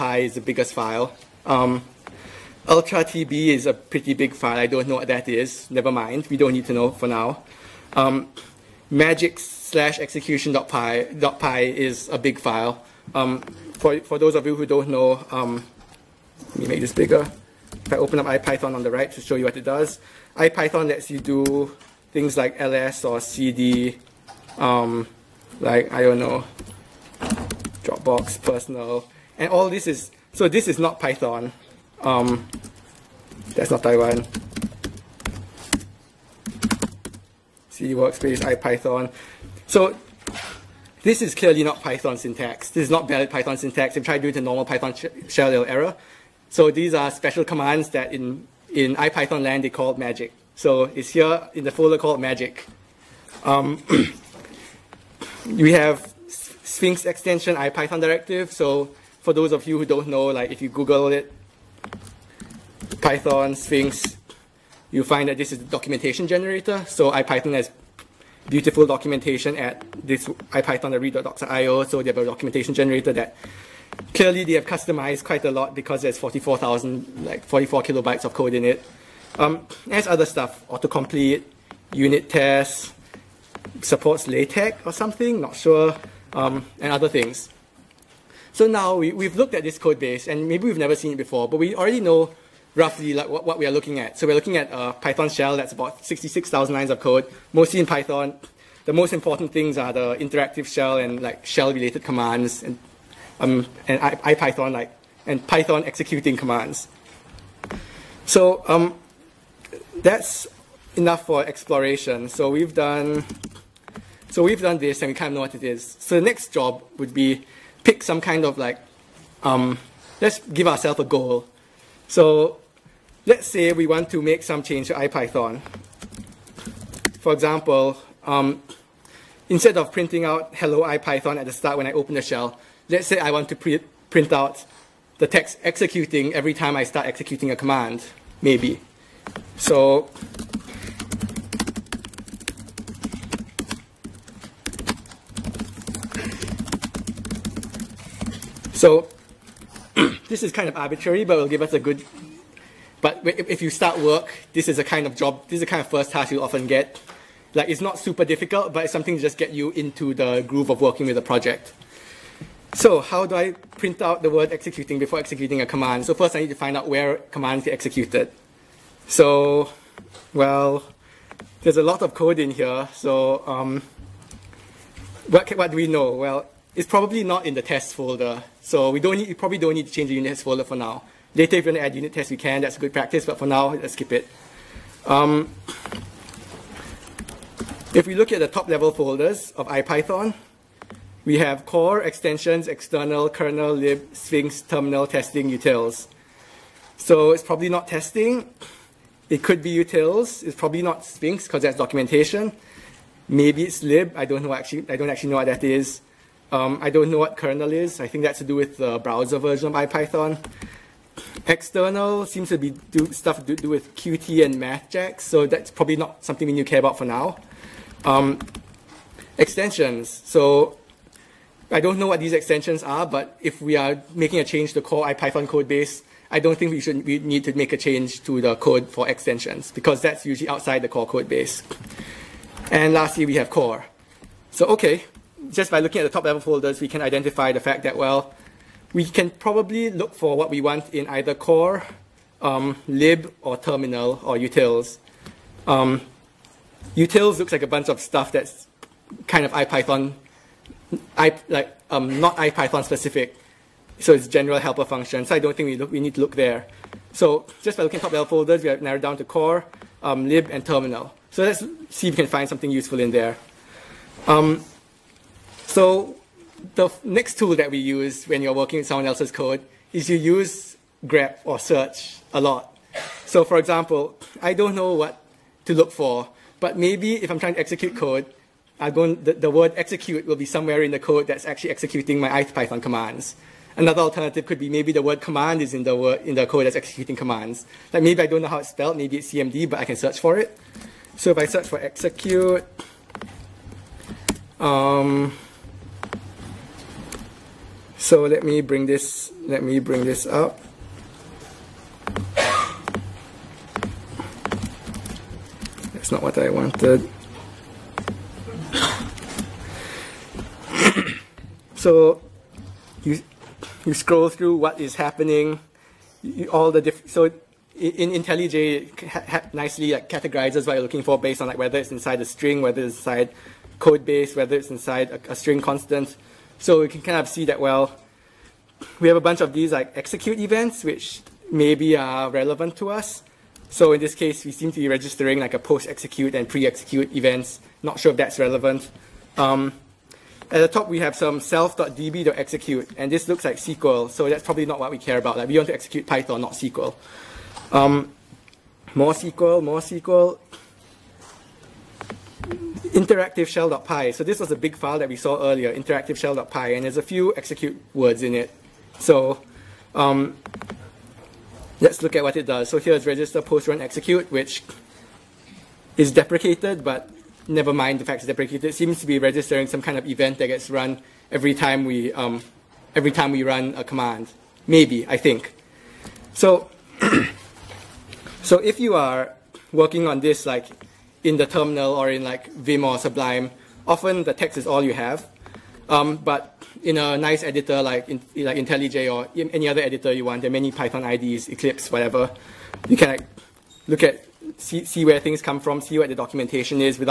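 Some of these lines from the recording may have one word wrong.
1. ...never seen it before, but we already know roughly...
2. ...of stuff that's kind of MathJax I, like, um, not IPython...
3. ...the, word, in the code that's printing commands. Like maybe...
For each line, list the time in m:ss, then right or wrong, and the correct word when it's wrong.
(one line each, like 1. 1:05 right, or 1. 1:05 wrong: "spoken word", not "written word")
1. 1:30 right
2. 4:07 wrong: "IPython", not "MathJax"
3. 4:45 wrong: "executing", not "printing".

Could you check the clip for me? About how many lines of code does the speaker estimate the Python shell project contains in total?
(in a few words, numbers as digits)
66,000.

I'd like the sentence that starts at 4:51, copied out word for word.
So if I search for execute, um, so let me bring this, let me bring this up.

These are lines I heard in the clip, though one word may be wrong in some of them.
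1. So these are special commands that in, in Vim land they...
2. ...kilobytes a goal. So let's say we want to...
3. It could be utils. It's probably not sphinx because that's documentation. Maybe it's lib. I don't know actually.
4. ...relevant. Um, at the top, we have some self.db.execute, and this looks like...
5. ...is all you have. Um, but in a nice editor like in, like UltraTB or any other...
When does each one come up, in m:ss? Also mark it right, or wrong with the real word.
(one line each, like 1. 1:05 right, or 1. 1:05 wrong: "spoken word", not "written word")
1. 0:46 wrong: "IPython", not "Vim"
2. 2:00 wrong: "ourselves", not "kilobytes"
3. 3:19 right
4. 5:38 right
5. 6:24 wrong: "IntelliJ", not "UltraTB".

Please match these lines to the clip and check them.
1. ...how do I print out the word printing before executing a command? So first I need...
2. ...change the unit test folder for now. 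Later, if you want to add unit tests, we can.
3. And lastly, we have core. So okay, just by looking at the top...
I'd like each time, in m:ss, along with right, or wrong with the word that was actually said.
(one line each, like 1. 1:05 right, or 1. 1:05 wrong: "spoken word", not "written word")
1. 2:43 wrong: "executing", not "printing"
2. 2:59 right
3. 3:52 right.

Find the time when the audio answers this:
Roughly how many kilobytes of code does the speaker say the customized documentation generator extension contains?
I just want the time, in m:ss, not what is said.
1:17.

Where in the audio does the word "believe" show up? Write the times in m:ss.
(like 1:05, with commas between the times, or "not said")
not said.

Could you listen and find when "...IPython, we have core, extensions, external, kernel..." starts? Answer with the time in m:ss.
3:09.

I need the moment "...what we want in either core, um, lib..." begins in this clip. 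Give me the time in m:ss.
4:00.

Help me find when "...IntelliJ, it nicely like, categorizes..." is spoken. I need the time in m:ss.
5:18.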